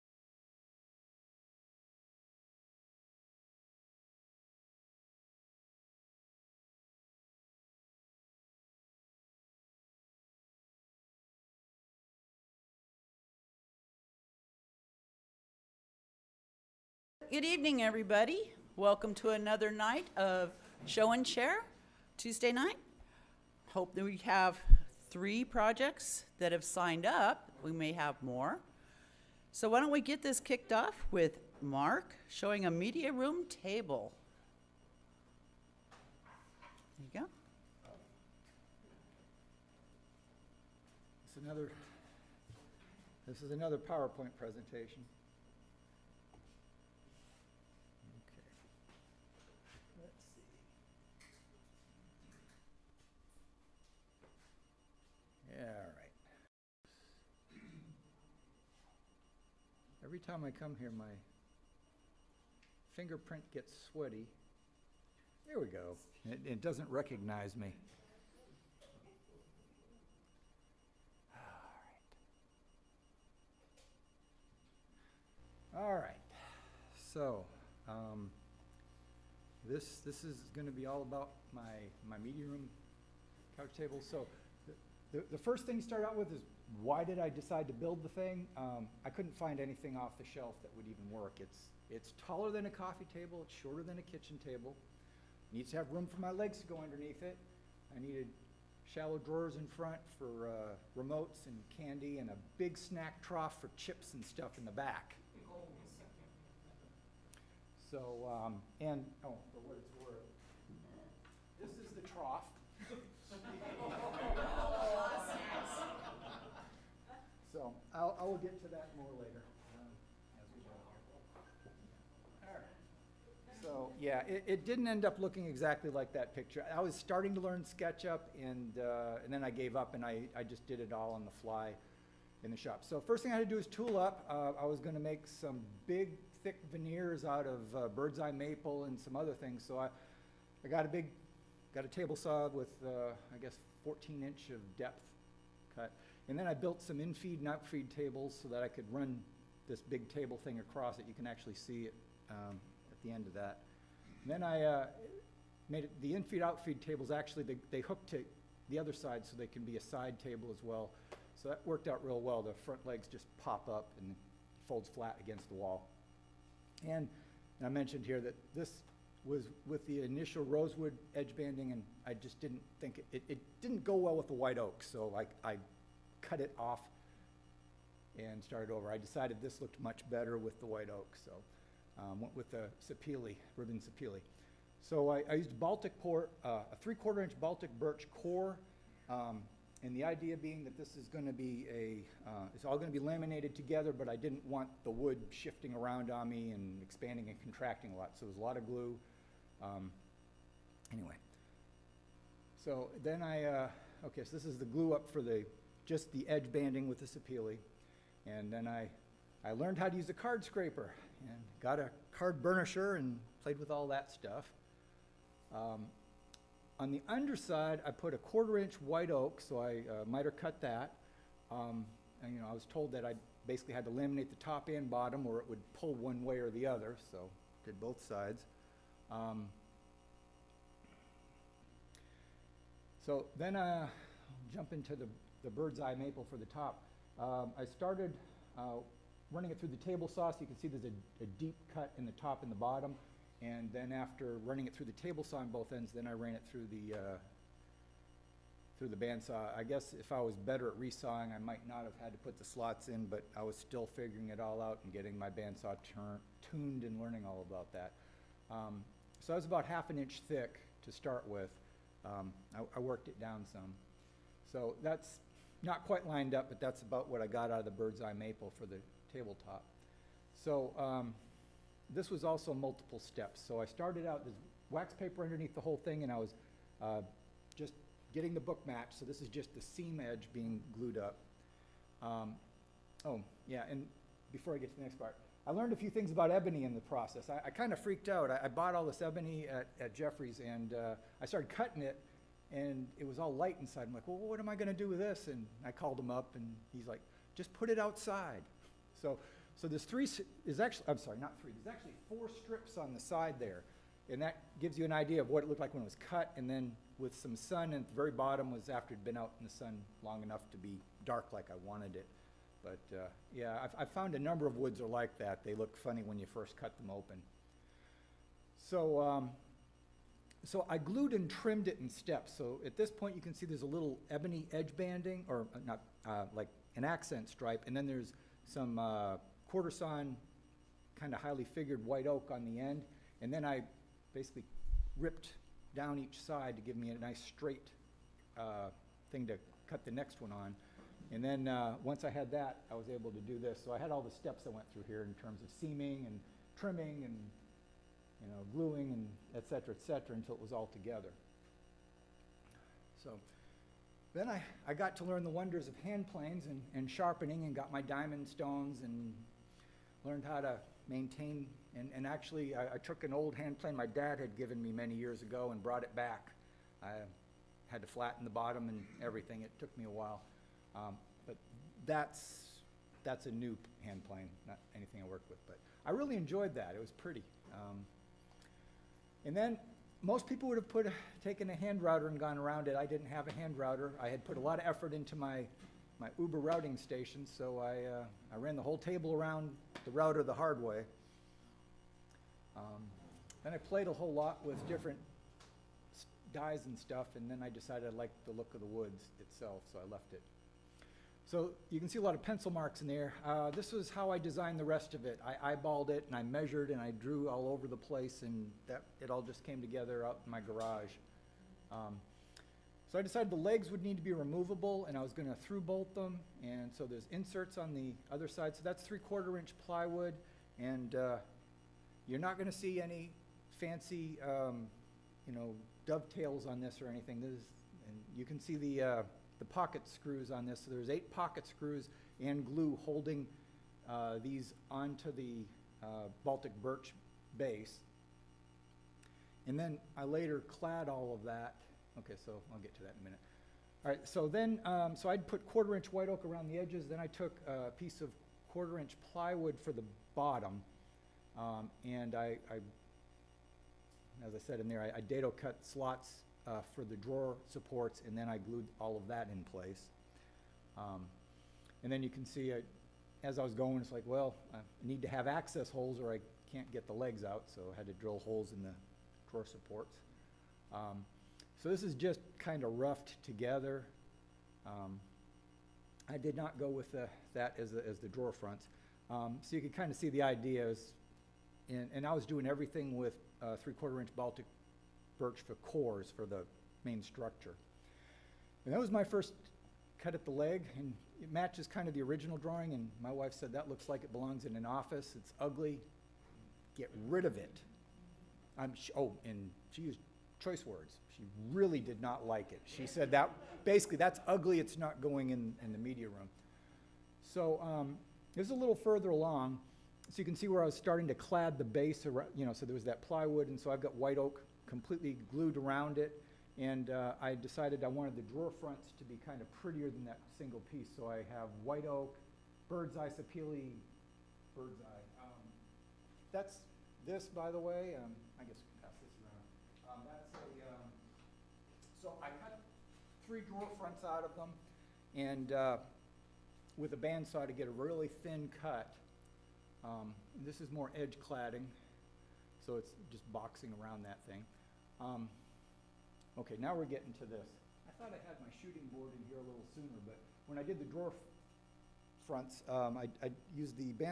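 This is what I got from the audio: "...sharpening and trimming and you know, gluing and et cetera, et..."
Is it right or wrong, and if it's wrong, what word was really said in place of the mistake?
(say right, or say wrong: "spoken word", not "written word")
wrong: "seaming", not "sharpening".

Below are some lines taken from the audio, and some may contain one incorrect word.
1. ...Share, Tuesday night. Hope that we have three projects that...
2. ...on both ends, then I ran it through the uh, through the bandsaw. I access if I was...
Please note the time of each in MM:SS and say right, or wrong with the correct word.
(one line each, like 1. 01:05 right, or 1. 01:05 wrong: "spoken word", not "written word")
1. 00:21 right
2. 04:05 wrong: "guess", not "access".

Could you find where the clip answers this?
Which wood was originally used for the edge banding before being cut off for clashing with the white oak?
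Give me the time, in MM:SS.
02:50.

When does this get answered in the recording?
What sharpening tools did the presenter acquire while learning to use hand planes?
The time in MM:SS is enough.
05:57.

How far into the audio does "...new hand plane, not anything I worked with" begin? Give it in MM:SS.
06:13.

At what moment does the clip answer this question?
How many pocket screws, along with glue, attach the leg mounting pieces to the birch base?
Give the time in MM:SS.
07:10.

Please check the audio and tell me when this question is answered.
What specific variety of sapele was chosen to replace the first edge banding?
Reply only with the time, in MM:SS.
03:03.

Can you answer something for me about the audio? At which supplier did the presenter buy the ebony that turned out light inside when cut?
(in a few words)
Jeffrey's.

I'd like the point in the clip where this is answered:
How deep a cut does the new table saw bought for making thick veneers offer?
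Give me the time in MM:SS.
02:23.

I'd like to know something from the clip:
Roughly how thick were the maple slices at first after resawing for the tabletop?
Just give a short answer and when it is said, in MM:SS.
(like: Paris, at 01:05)
Half an inch, at 04:19.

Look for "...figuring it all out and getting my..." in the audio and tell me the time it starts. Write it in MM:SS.
04:13.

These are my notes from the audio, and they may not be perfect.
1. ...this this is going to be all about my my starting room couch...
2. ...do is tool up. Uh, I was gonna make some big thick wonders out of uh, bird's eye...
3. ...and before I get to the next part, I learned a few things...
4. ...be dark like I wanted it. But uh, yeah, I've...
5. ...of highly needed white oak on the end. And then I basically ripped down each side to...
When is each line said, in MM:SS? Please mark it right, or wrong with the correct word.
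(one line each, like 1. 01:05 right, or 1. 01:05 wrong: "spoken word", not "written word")
1. 01:19 wrong: "meeting", not "starting"
2. 02:13 wrong: "veneers", not "wonders"
3. 04:43 right
4. 05:10 right
5. 05:31 wrong: "figured", not "needed".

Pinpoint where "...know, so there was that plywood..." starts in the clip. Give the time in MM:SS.
08:32.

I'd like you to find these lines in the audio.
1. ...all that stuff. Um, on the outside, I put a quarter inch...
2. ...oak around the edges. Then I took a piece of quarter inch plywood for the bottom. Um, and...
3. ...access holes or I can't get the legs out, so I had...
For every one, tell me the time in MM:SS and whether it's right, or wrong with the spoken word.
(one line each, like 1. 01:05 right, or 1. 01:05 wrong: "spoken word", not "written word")
1. 03:33 wrong: "underside", not "outside"
2. 07:26 right
3. 07:45 right.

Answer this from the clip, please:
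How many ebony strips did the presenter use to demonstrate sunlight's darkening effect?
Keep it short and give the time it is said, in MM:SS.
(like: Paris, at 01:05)
4, at 05:02.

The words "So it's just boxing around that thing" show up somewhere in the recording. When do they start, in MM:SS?
09:02.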